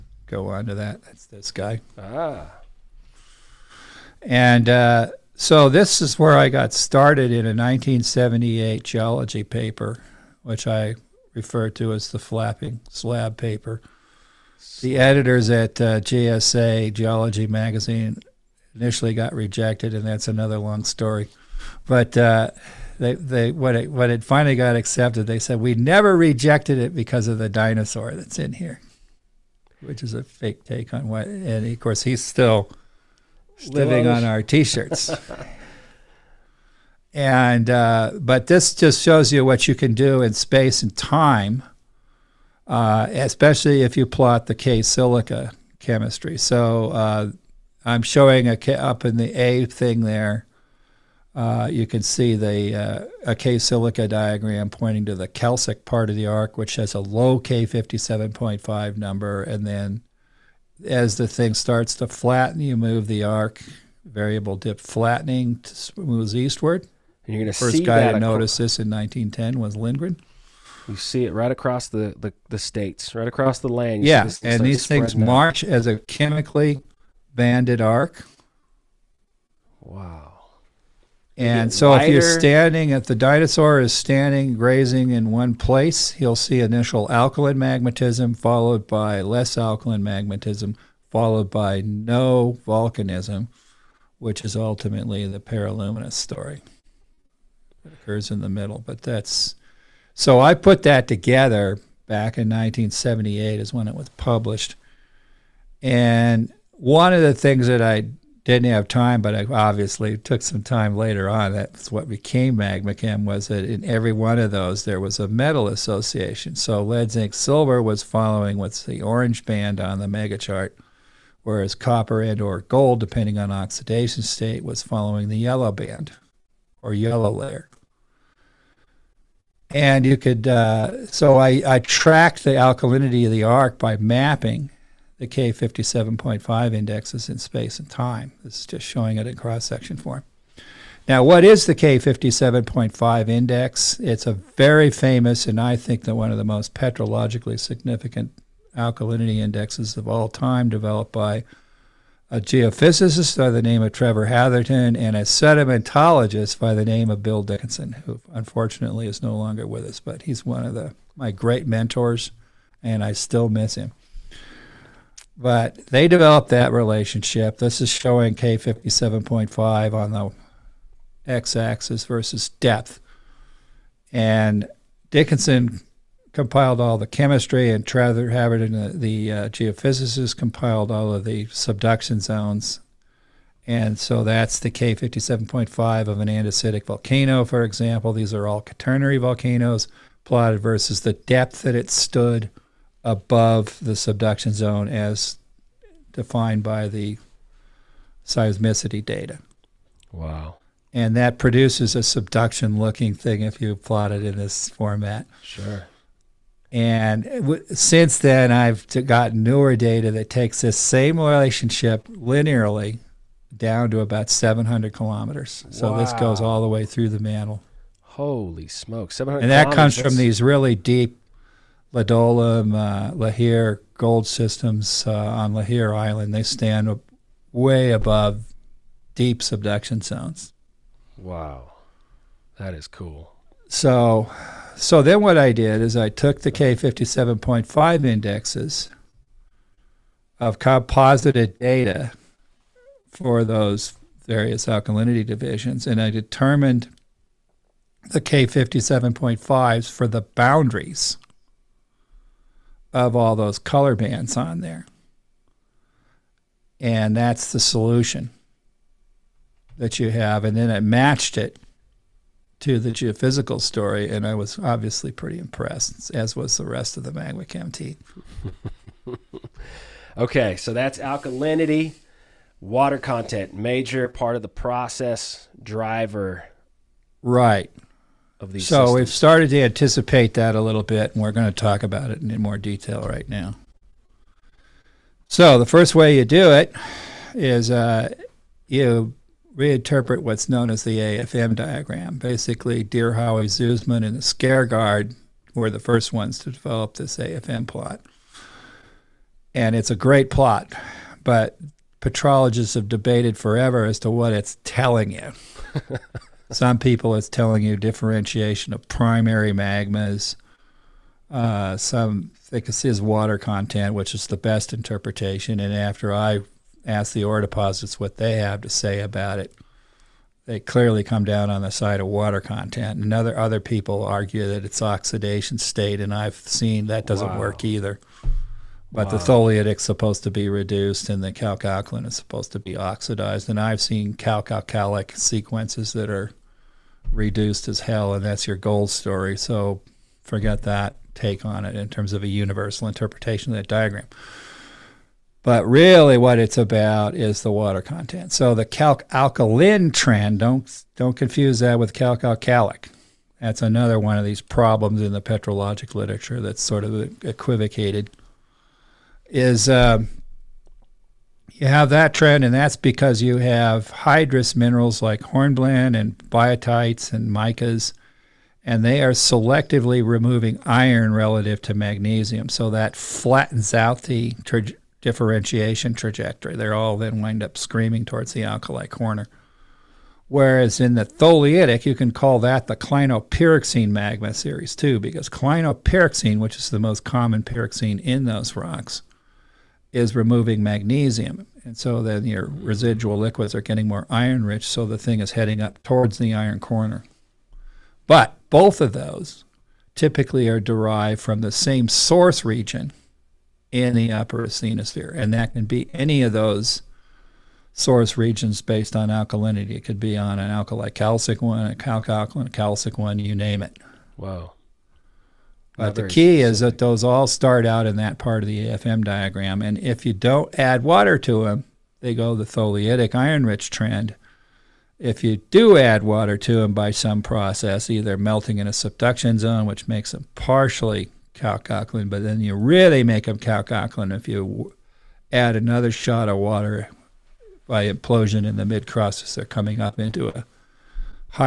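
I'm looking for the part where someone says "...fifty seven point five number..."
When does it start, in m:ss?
0:57.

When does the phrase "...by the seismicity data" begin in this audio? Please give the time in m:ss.
3:16.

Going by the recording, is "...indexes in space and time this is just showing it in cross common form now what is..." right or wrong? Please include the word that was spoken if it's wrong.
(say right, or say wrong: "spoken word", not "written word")
wrong: "section", not "common".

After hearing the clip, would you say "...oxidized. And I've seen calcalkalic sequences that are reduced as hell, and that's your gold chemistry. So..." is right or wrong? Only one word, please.
wrong.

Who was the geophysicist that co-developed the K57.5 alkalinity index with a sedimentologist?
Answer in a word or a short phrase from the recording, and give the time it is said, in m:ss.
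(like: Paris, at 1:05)
Trevor Hatherton, at 2:33.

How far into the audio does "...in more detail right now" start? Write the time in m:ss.
4:42.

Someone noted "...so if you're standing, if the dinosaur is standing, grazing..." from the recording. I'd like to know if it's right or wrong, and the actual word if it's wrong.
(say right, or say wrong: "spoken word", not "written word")
right.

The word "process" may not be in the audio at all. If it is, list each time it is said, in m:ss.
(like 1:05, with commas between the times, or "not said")
4:34, 7:07.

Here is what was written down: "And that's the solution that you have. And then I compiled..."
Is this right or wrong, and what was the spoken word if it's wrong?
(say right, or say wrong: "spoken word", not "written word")
wrong: "matched", not "compiled".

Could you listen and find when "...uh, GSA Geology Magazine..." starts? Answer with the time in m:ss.
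0:15.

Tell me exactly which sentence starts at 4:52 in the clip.
Basically, Deerhowie, Zussman, and Skaergaard were the first ones to develop this AFM plot.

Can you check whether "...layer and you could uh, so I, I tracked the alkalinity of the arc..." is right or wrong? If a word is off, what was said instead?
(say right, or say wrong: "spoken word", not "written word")
right.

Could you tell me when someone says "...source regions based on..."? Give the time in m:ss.
6:47.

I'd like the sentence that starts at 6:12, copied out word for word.
So that flattens out the tra differentiation trajectory.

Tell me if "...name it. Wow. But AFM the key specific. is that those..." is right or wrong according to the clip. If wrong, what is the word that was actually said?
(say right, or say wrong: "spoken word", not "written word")
wrong: "Not", not "AFM".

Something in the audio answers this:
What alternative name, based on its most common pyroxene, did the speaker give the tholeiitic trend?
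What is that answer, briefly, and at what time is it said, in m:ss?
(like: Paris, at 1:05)
clinopyroxene magma series, at 6:22.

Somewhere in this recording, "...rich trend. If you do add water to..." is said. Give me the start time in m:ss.
7:03.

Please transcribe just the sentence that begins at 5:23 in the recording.
And other, other people argue that it's oxidation state, and I've seen that doesn't wow.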